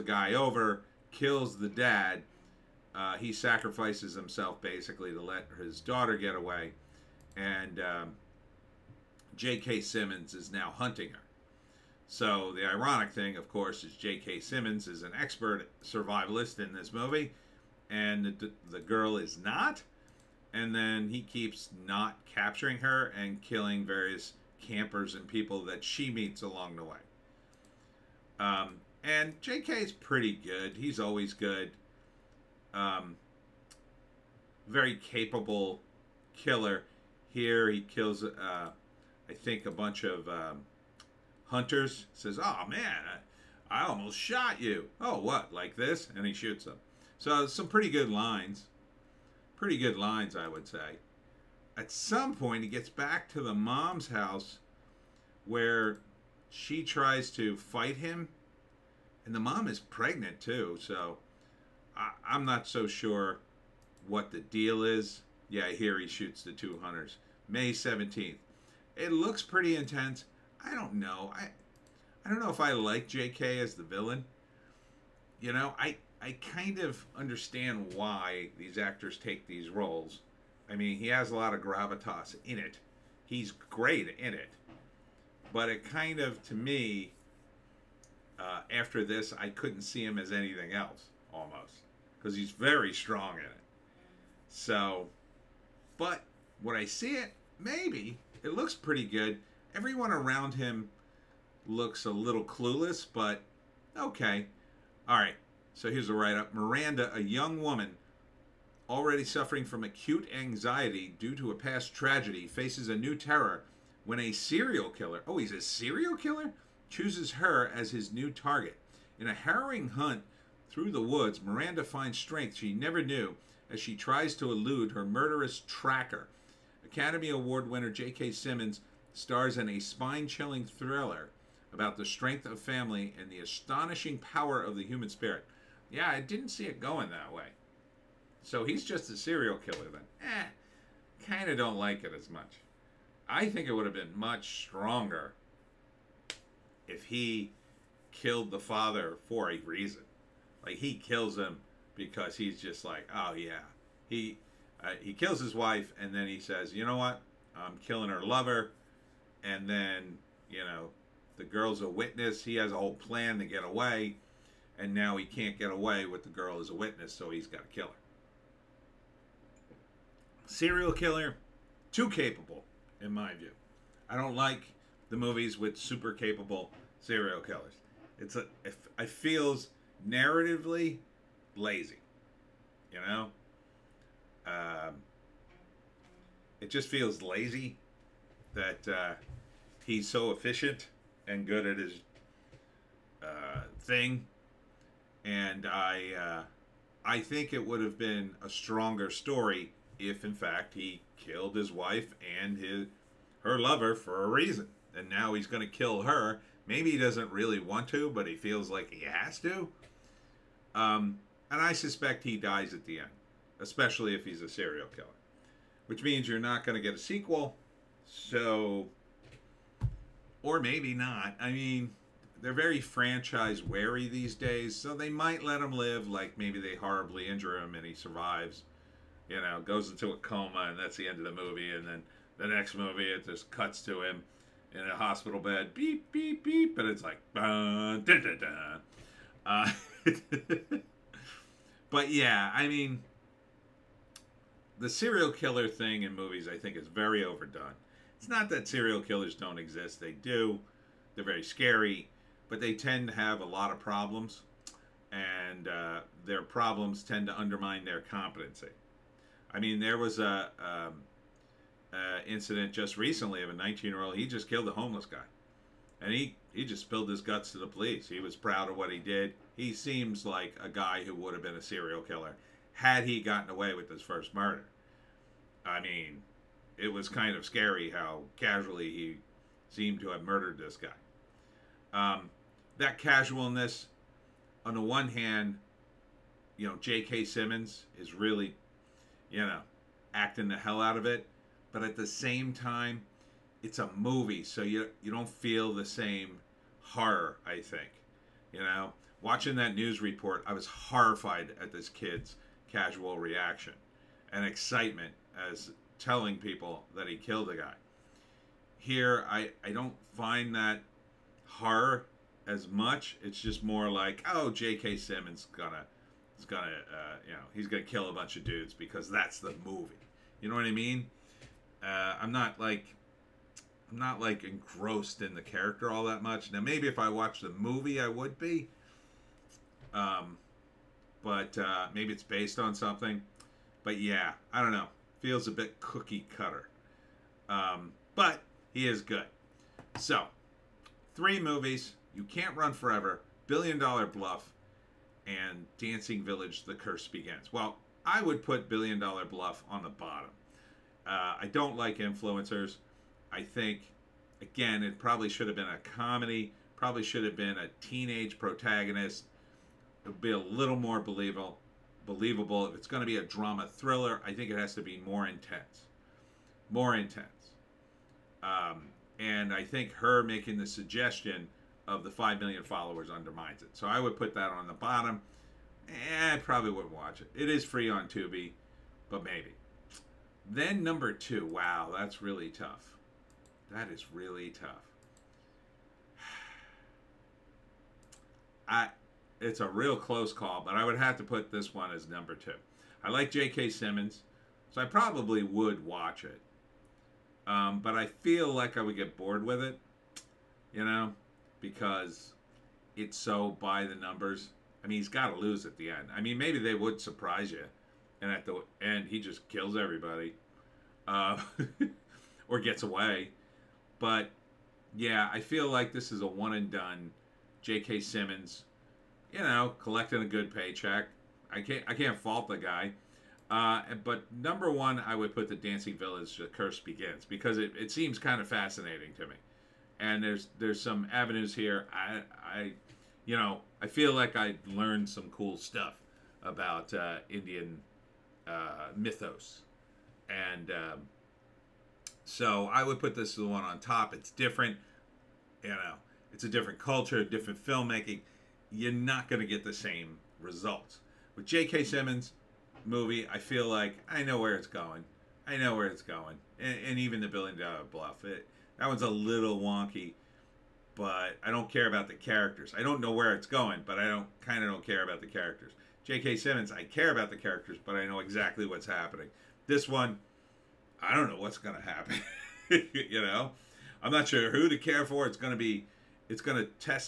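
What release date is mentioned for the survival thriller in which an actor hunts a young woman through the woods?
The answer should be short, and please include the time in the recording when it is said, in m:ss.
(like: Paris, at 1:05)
May 17, at 1:07.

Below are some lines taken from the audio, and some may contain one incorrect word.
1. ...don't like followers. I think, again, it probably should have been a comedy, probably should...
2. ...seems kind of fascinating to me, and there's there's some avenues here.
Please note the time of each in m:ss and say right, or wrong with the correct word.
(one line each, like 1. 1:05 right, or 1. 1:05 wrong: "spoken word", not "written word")
1. 5:51 wrong: "influencers", not "followers"
2. 7:07 right.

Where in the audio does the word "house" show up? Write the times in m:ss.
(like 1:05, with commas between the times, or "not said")
0:54.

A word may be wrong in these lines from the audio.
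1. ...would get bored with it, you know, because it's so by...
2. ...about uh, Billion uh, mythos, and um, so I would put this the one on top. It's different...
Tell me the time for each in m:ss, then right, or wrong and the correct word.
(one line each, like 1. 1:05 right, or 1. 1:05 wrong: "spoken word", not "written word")
1. 6:38 right
2. 7:16 wrong: "Indian", not "Billion".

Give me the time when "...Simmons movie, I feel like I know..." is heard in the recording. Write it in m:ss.
7:31.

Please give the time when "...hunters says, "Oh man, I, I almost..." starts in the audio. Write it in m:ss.
0:41.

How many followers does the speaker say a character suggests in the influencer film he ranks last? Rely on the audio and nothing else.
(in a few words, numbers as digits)
5 million.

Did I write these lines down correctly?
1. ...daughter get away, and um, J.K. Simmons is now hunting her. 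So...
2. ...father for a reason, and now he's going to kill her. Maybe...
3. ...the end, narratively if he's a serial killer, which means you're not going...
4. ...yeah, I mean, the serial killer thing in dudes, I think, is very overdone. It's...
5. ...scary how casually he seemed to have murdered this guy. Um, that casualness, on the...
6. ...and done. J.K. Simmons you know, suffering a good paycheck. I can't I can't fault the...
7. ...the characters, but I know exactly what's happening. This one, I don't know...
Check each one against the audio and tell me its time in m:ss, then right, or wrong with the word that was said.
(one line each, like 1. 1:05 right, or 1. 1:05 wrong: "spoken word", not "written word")
1. 0:05 right
2. 3:23 wrong: "lover", not "father"
3. 3:32 wrong: "especially", not "narratively"
4. 4:02 wrong: "movies", not "dudes"
5. 4:37 right
6. 6:56 wrong: "collecting", not "suffering"
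7. 7:47 right.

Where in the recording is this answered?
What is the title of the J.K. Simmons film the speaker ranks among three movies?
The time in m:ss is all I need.
5:42.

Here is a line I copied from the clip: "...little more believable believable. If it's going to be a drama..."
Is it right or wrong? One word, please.
right.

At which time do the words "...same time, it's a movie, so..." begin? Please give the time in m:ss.
4:52.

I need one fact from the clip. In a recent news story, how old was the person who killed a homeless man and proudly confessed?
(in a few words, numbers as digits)
19.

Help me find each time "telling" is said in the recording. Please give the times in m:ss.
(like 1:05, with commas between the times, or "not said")
5:06.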